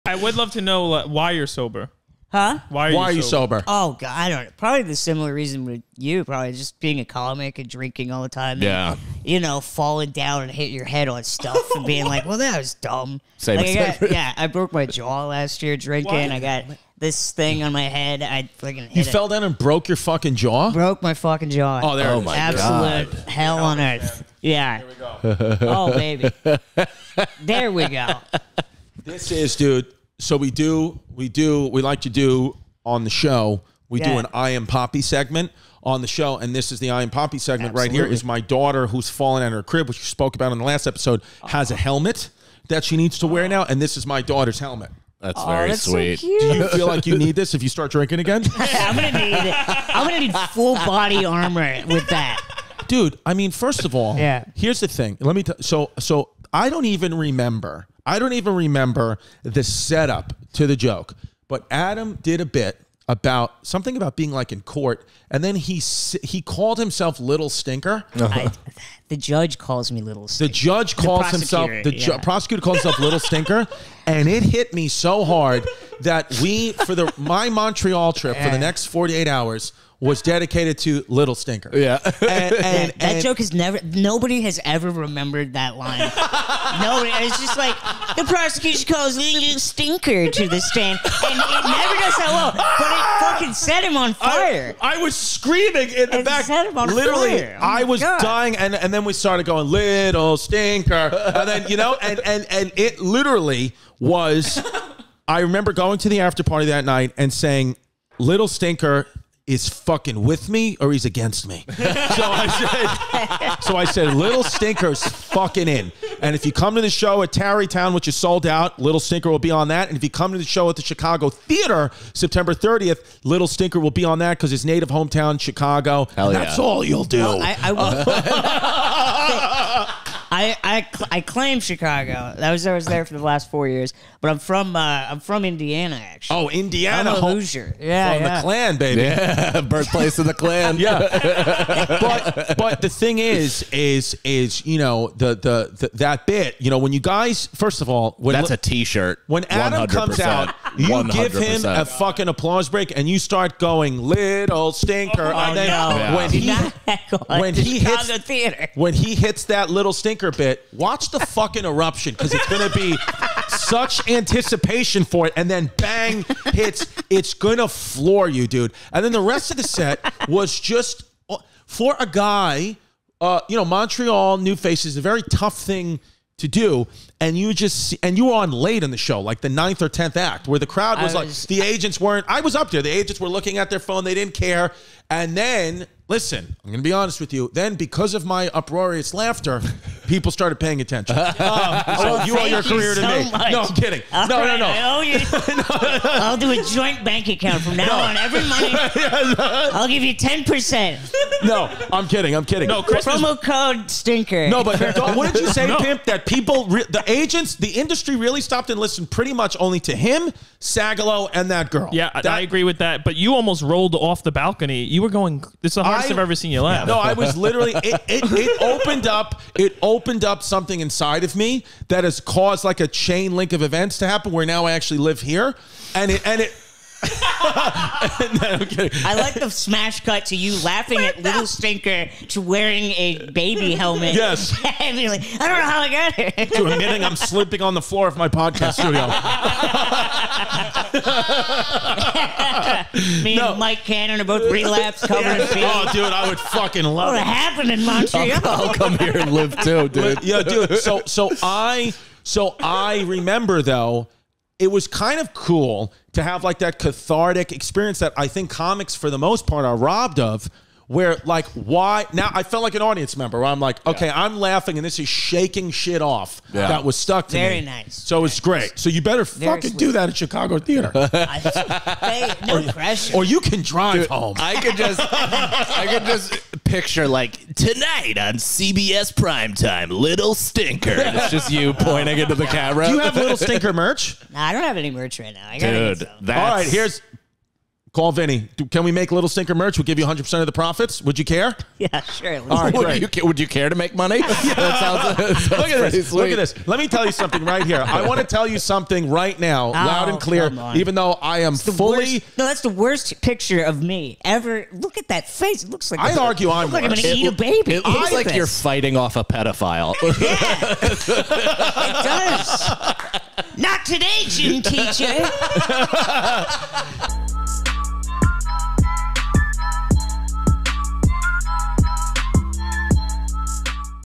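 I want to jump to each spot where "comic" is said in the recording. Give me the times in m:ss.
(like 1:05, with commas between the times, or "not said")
0:07, 4:18.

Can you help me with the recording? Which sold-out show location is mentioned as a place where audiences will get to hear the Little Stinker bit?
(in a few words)
Tarrytown.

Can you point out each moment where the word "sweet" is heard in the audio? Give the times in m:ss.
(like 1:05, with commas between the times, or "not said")
0:45, 4:29, 4:56.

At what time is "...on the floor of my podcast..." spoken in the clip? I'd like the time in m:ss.
3:57.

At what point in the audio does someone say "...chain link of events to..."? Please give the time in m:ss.
3:42.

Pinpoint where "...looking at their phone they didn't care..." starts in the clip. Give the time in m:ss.
3:03.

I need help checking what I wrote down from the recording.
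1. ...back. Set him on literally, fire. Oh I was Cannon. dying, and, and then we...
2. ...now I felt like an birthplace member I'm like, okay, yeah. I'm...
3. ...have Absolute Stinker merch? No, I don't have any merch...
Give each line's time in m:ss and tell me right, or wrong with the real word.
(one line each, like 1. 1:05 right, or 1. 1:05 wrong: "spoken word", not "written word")
1. 1:36 wrong: "God", not "Cannon"
2. 4:22 wrong: "audience", not "birthplace"
3. 4:42 wrong: "Little", not "Absolute".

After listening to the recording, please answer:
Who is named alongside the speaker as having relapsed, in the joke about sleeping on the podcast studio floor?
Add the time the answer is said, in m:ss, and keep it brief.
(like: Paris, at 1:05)
Mike Cannon, at 4:03.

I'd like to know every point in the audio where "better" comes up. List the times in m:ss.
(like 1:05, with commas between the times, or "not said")
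4:29.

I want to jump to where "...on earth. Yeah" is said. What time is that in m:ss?
0:23.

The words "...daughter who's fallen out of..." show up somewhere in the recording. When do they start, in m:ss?
0:38.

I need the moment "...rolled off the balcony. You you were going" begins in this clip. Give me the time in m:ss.
3:33.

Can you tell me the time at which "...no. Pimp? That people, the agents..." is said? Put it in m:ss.
3:25.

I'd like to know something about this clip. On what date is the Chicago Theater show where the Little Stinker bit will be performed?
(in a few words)
September 30.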